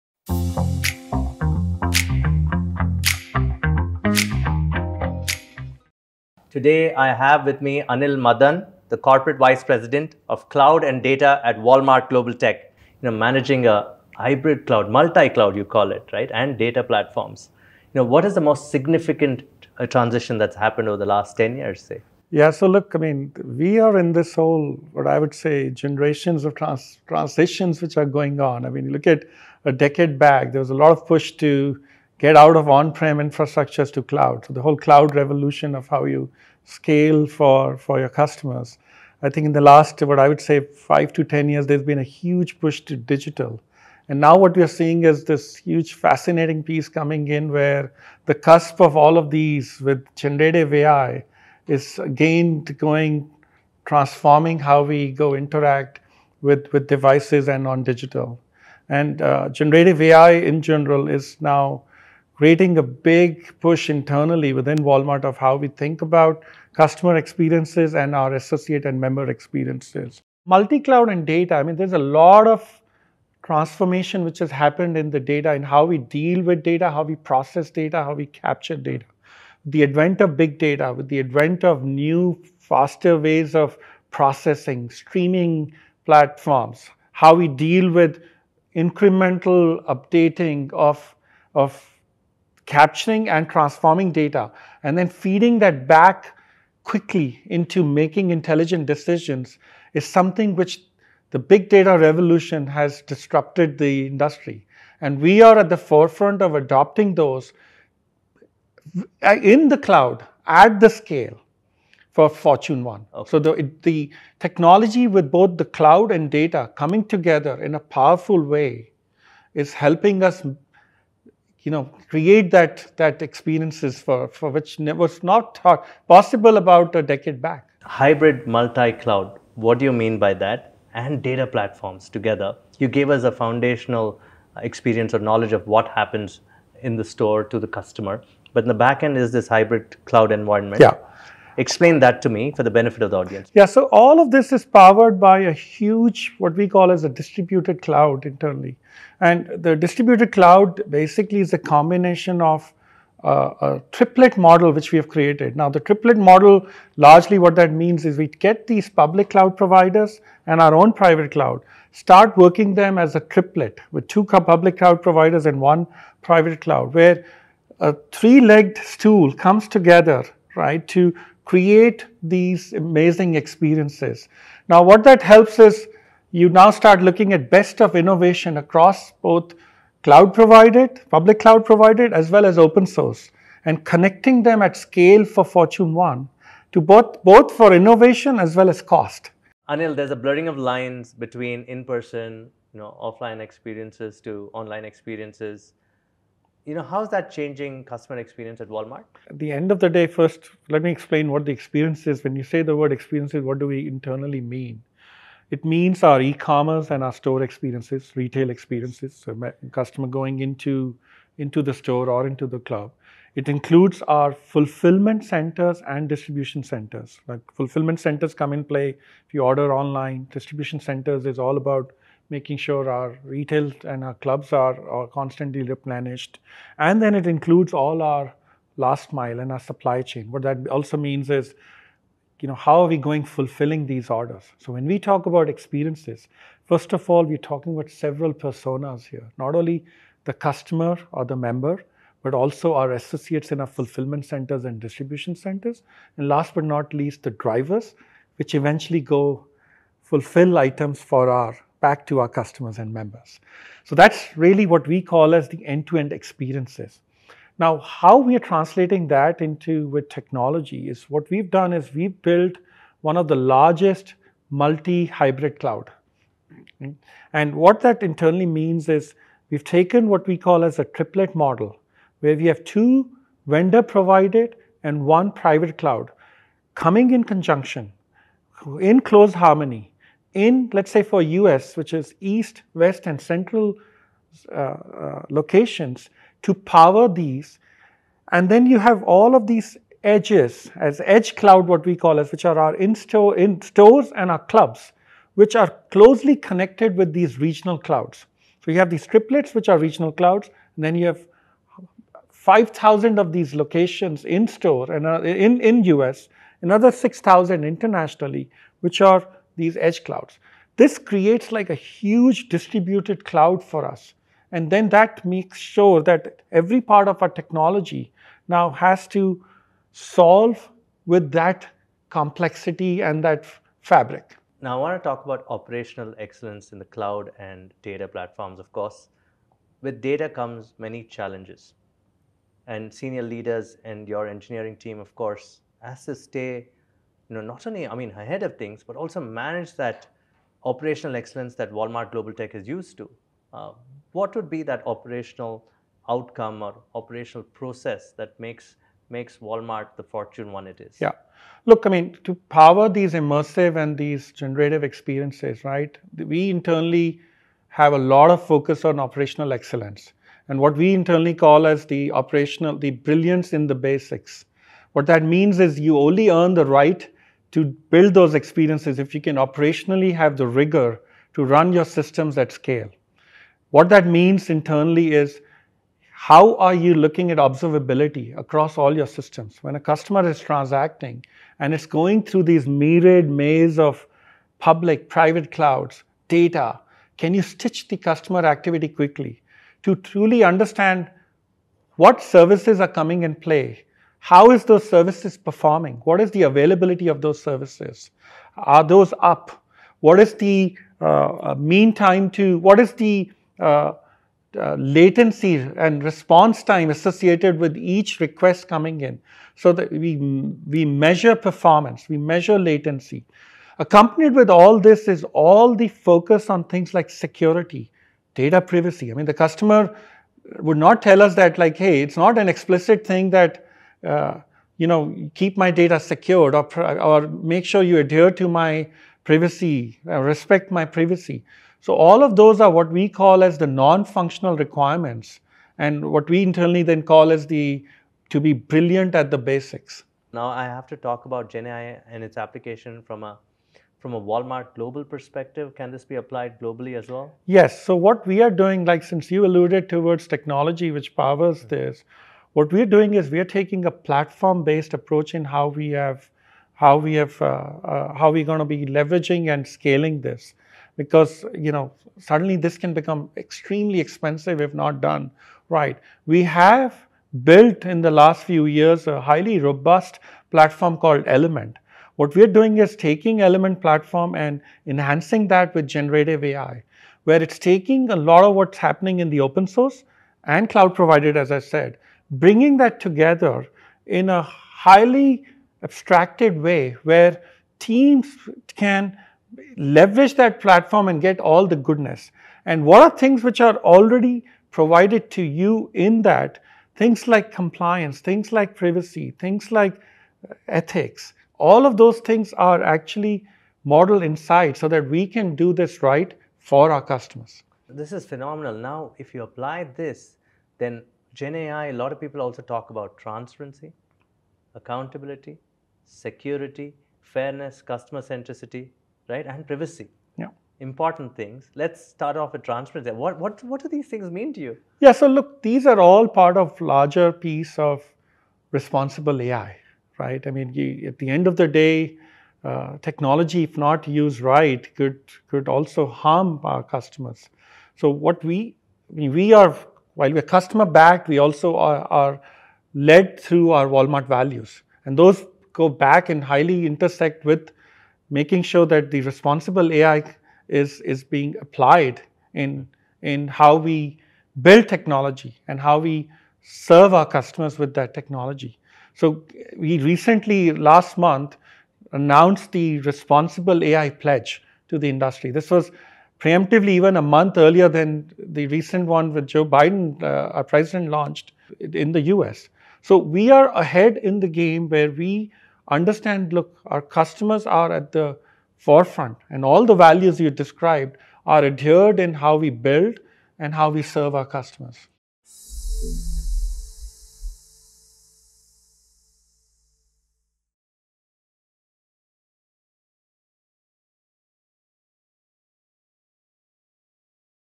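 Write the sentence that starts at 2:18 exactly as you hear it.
But in the back end is this hybrid cloud environment.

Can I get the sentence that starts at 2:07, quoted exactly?
Hybrid multi-cloud, what do you mean by that?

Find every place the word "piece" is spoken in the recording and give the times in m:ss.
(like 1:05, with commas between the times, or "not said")
0:46, 8:47.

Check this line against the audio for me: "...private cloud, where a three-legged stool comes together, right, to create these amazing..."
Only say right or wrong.
right.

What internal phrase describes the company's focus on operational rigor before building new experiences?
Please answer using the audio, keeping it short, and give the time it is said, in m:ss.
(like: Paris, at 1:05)
Brilliance in the basics, at 6:02.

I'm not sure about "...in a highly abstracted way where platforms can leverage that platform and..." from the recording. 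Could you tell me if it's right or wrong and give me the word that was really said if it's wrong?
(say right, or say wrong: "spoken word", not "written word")
wrong: "teams", not "platforms".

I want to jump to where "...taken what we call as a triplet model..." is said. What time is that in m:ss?
4:29.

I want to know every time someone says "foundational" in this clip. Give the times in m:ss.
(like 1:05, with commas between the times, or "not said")
2:13.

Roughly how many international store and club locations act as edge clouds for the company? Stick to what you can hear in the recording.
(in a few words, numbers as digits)
6,000.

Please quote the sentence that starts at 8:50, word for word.
I mean, you, at the end of the day, uh, technology, if not used right, could, could also harm our customers.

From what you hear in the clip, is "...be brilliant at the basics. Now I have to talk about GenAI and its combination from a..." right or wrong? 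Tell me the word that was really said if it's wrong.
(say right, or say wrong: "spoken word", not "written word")
wrong: "application", not "combination".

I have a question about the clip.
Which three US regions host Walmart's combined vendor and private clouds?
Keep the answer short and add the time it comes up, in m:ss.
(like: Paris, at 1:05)
East, west, and central, at 4:42.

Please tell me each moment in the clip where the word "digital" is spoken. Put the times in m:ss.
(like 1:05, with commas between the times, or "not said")
0:42, 0:57.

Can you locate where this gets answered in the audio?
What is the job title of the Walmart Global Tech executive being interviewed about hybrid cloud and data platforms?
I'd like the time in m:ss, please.
0:08.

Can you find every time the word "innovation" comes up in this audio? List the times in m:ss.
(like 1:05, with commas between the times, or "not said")
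2:57, 3:07.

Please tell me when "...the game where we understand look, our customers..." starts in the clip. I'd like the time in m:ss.
9:34.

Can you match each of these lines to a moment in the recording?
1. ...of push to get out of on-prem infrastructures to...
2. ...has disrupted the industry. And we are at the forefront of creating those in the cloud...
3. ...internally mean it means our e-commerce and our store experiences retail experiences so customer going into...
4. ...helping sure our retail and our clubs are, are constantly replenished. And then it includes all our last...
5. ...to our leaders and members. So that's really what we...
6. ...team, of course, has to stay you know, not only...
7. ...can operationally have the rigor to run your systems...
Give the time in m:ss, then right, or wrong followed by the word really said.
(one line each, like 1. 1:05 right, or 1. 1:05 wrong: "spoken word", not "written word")
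1. 0:30 right
2. 1:42 wrong: "adopting", not "creating"
3. 3:23 right
4. 3:42 wrong: "making", not "helping"
5. 4:12 wrong: "customers", not "leaders"
6. 5:34 right
7. 6:09 right.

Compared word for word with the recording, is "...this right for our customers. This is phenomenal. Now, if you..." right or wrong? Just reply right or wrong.
right.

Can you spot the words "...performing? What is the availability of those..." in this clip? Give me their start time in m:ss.
6:35.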